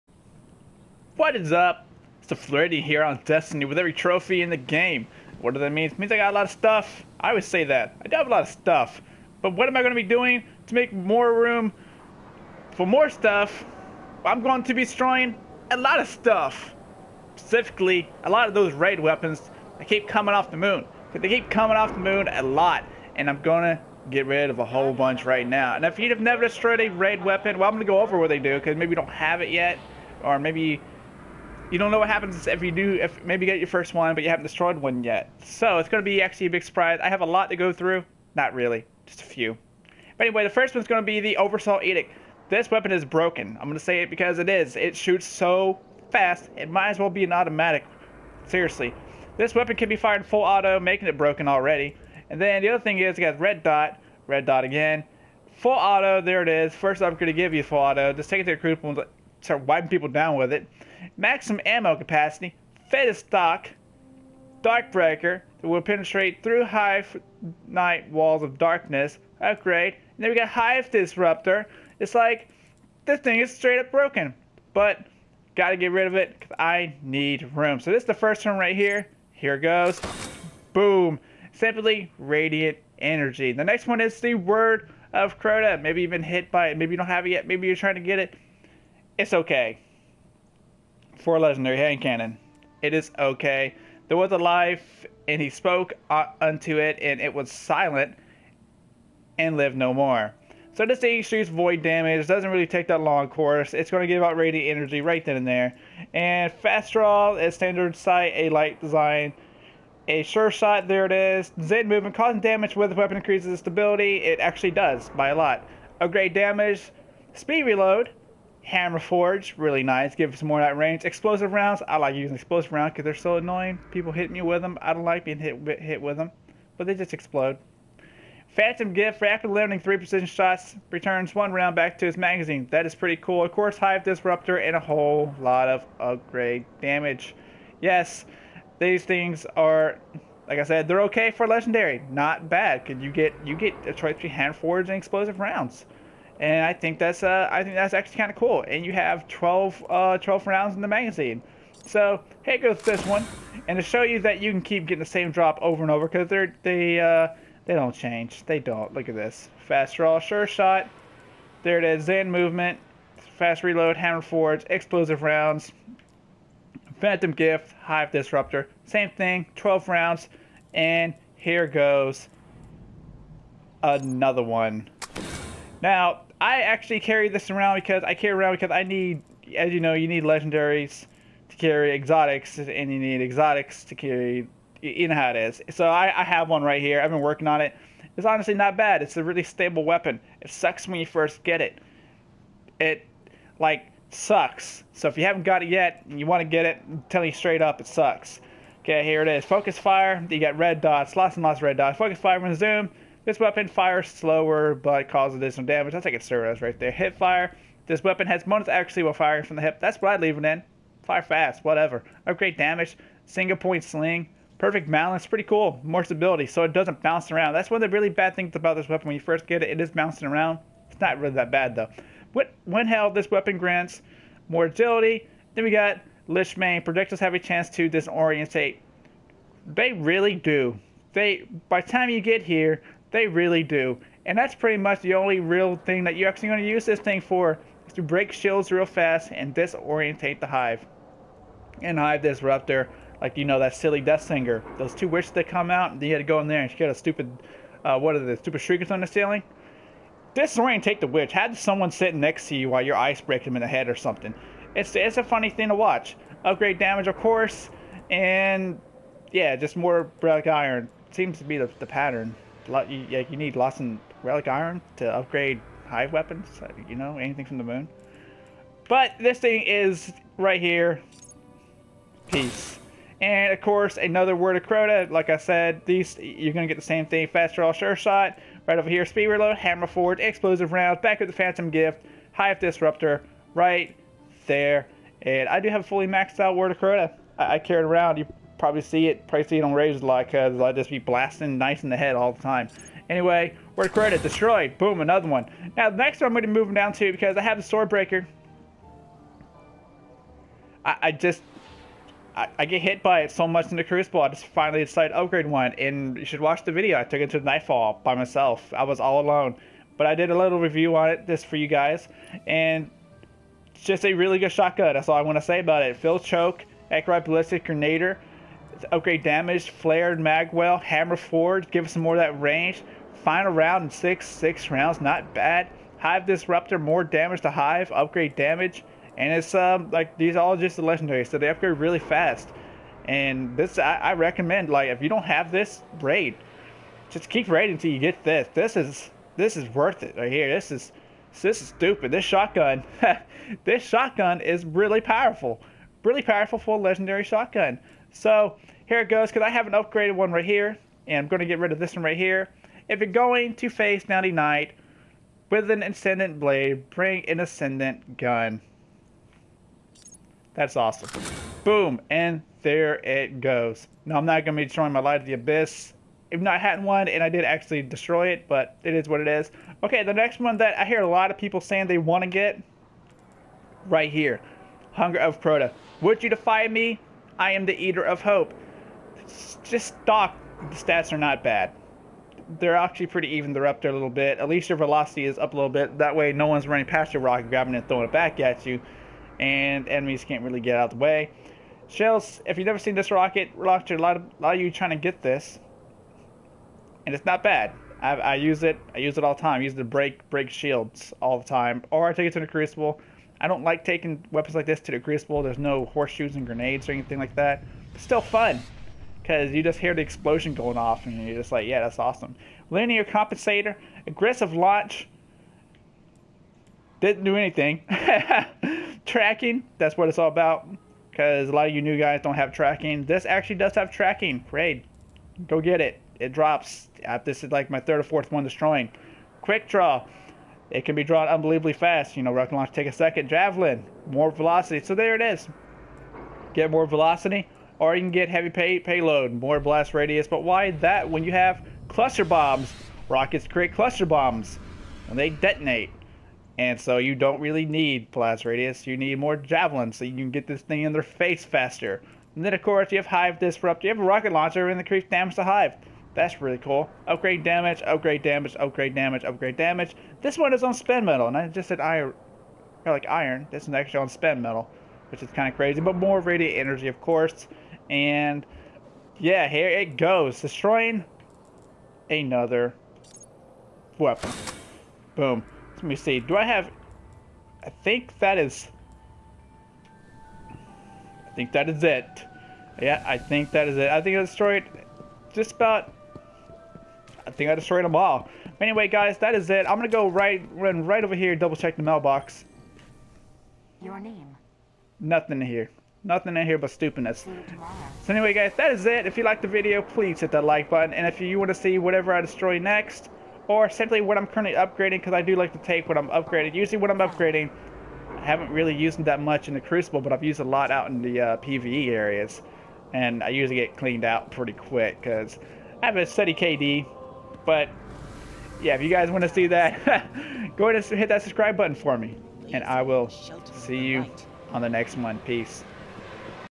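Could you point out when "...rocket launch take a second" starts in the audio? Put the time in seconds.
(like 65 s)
432 s.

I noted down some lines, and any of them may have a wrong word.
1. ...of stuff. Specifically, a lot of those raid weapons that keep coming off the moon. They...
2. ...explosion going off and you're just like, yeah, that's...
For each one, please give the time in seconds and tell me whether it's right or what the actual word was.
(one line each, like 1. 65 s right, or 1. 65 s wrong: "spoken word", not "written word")
1. 15 s right
2. 410 s right.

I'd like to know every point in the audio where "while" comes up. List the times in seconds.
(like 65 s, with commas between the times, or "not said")
209 s, 252 s.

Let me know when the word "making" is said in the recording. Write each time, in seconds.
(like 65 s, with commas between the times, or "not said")
50 s.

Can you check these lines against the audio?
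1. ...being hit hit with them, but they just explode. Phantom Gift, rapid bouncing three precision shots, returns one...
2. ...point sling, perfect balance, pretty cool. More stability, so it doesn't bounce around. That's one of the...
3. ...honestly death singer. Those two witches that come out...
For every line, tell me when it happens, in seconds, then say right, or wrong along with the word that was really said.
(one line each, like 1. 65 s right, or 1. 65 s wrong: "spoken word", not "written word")
1. 125 s wrong: "limiting", not "bouncing"
2. 213 s right
3. 243 s wrong: "silly", not "honestly".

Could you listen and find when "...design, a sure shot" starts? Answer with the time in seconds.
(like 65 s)
108 s.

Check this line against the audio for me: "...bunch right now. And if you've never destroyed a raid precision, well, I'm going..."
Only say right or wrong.
wrong.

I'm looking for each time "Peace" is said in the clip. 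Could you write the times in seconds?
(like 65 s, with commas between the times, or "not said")
272 s, 525 s.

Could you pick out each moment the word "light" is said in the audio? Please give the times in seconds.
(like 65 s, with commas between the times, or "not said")
108 s, 364 s.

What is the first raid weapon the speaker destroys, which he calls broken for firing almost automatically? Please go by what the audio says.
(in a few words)
Oversoul Edict.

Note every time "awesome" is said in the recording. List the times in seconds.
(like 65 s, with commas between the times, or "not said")
360 s, 411 s.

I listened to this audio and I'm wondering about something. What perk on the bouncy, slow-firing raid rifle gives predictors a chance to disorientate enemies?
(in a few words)
Lich Bane.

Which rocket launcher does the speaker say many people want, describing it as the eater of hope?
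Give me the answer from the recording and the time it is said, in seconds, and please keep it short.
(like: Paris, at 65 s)
Hunger of Crota, at 374 s.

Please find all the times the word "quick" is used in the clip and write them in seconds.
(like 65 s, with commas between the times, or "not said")
429 s, 514 s.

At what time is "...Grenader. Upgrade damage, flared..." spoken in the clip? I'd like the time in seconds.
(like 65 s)
317 s.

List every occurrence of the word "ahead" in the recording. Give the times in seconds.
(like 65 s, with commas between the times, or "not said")
520 s.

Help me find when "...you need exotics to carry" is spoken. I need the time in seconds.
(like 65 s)
182 s.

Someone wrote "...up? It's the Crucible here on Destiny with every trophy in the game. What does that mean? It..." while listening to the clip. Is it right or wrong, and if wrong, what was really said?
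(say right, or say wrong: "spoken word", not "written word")
wrong: "Flirty", not "Crucible".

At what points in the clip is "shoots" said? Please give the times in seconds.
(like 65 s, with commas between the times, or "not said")
44 s, 101 s.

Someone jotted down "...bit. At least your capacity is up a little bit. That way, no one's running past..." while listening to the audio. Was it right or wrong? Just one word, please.
wrong.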